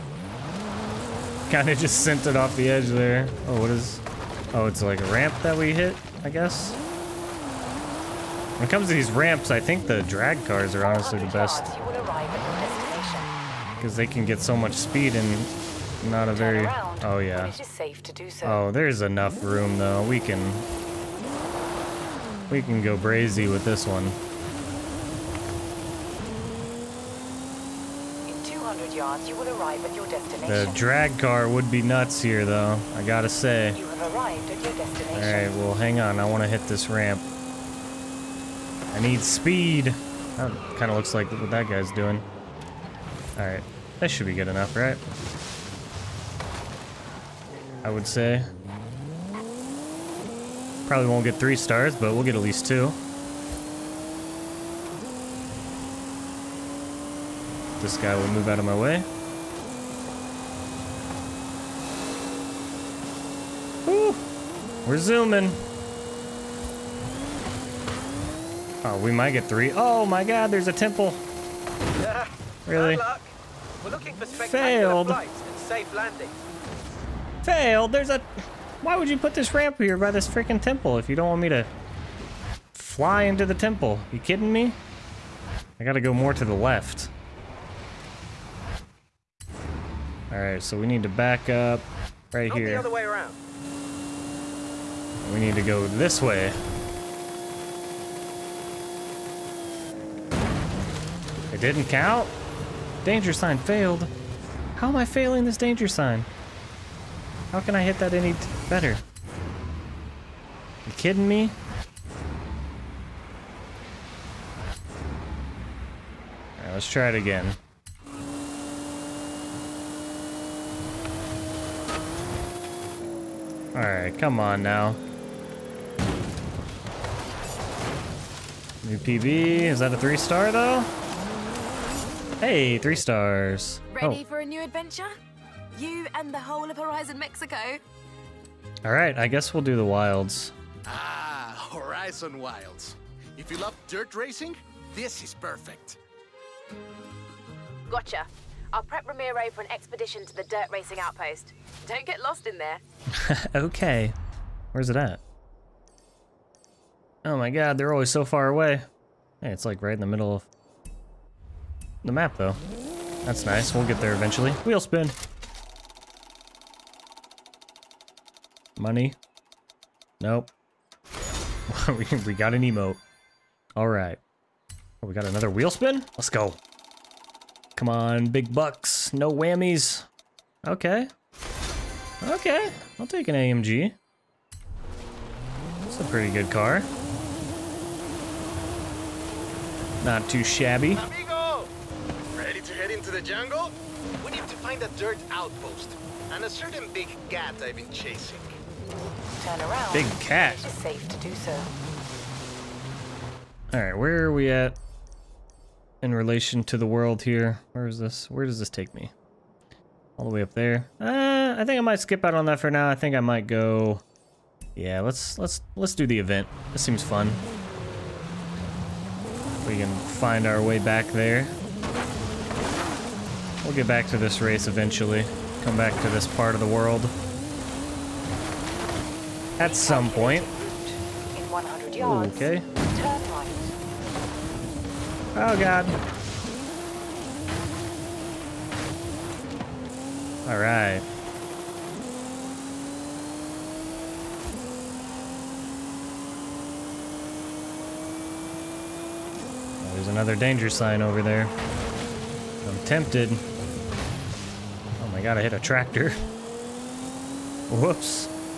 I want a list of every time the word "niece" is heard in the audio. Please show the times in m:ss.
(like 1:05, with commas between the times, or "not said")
not said.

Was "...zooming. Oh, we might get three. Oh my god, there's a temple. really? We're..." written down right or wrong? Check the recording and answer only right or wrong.
right.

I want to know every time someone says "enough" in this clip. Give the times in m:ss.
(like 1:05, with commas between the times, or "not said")
0:18, 0:44.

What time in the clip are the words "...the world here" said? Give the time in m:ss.
3:26.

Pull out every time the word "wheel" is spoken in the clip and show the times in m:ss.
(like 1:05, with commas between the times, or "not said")
2:44, 2:55.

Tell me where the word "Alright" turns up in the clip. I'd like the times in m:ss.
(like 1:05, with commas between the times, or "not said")
1:30, 2:03.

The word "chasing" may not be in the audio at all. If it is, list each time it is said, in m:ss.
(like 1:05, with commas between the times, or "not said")
3:17.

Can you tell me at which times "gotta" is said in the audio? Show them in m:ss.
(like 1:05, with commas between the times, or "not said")
0:33, 1:25.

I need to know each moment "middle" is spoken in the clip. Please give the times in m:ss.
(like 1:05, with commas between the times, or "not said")
2:40.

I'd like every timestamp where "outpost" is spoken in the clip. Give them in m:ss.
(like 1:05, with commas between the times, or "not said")
2:30, 3:15.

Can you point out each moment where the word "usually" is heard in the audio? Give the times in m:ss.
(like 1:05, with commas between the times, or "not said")
not said.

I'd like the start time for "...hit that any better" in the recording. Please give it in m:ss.
1:47.